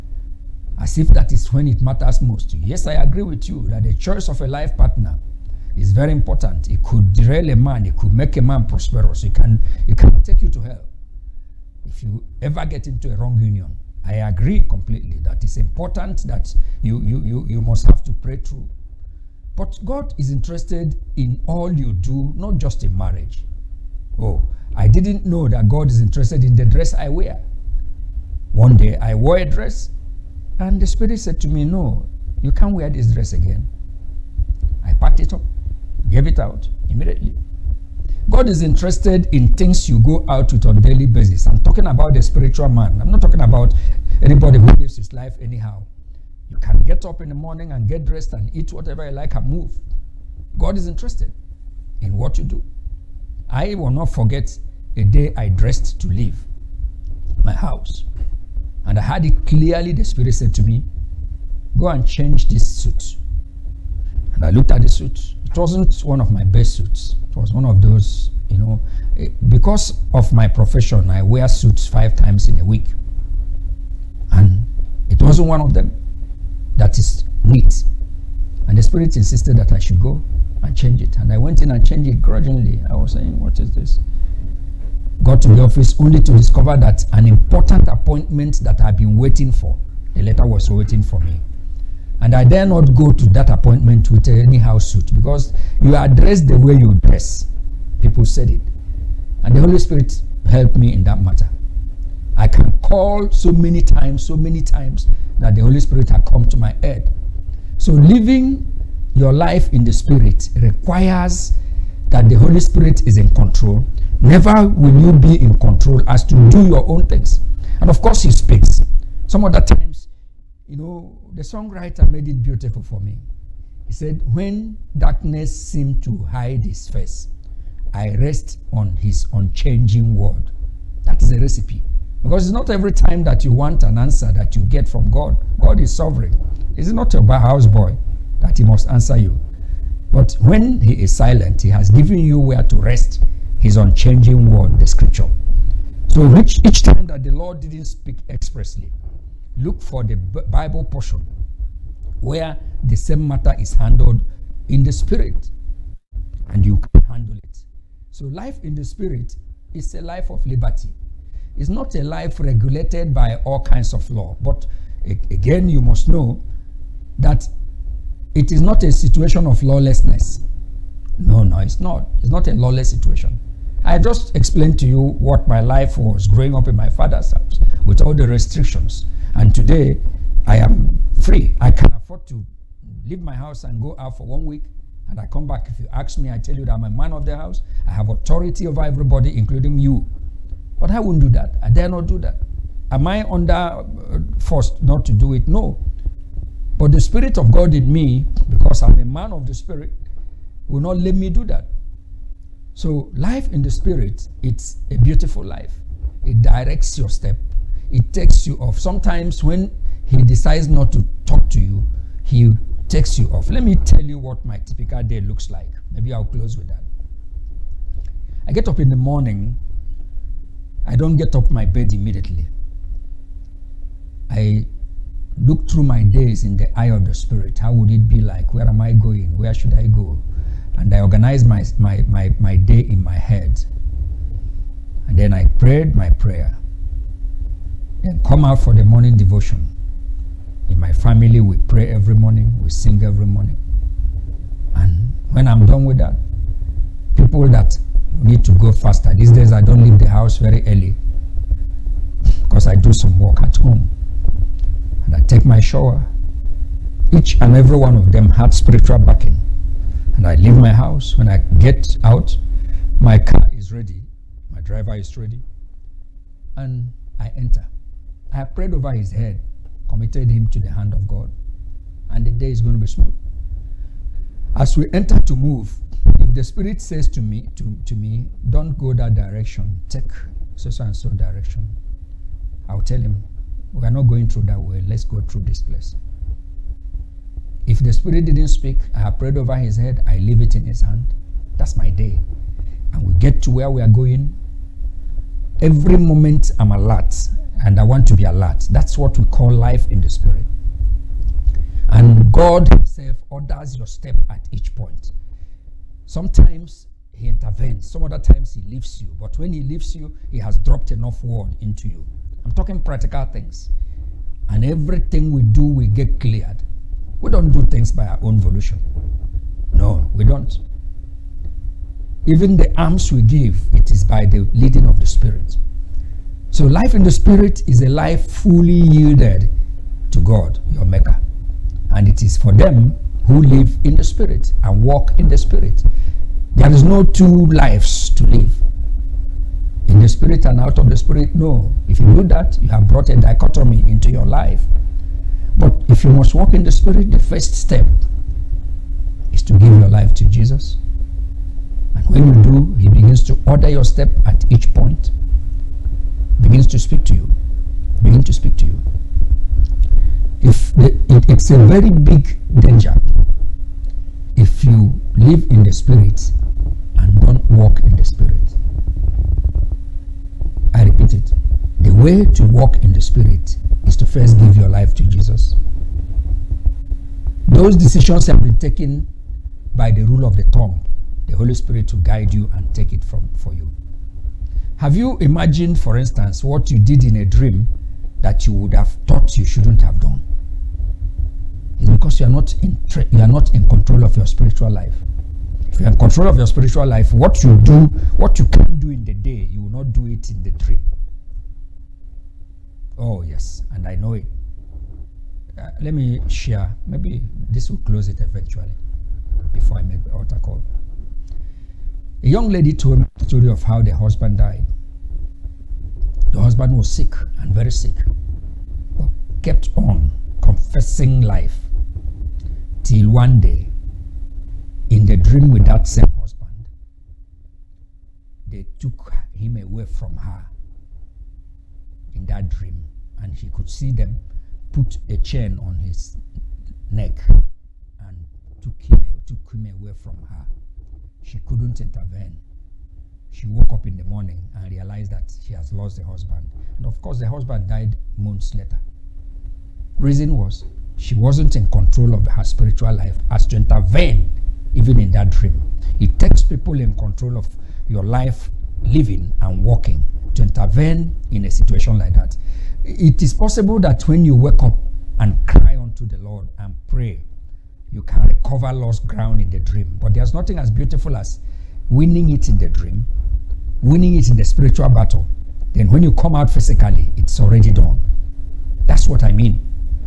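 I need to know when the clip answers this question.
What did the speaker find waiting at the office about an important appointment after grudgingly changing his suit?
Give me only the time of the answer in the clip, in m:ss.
1:30.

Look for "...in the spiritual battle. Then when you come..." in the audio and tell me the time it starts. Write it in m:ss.
7:54.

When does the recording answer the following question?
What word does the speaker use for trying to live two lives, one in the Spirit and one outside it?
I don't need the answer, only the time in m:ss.
5:43.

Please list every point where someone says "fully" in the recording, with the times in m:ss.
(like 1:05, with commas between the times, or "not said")
5:28.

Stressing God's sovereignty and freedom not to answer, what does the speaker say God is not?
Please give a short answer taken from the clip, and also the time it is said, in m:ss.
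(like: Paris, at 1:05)
Houseboy, at 2:17.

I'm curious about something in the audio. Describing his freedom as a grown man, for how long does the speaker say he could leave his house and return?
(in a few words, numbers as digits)
One week.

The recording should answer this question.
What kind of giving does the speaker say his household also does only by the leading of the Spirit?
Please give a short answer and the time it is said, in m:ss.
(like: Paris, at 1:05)
Alms, at 5:22.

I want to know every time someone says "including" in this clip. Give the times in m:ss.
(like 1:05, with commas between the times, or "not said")
3:09.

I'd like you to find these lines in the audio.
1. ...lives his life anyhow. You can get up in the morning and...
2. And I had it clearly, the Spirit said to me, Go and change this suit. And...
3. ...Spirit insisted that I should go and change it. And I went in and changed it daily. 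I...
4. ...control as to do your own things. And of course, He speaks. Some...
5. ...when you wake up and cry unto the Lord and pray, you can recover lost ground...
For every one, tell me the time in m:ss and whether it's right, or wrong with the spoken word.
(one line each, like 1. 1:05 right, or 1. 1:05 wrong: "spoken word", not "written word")
1. 0:44 right
2. 0:58 right
3. 1:18 wrong: "grudgingly", not "daily"
4. 1:55 right
5. 7:44 right.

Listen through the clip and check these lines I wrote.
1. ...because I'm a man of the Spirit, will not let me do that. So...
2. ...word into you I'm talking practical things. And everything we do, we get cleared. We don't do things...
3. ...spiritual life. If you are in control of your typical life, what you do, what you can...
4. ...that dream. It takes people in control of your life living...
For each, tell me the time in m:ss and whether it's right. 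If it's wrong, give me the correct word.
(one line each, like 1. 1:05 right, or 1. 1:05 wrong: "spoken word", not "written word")
1. 3:18 right
2. 5:11 right
3. 6:34 wrong: "spiritual", not "typical"
4. 7:35 right.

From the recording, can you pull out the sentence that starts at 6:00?
If the, it, it's a very big danger if you live in the spirit and don't walk in the spirit.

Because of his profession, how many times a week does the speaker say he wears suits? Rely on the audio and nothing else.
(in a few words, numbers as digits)
5 times.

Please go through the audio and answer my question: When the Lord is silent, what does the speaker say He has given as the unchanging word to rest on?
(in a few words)
The scripture.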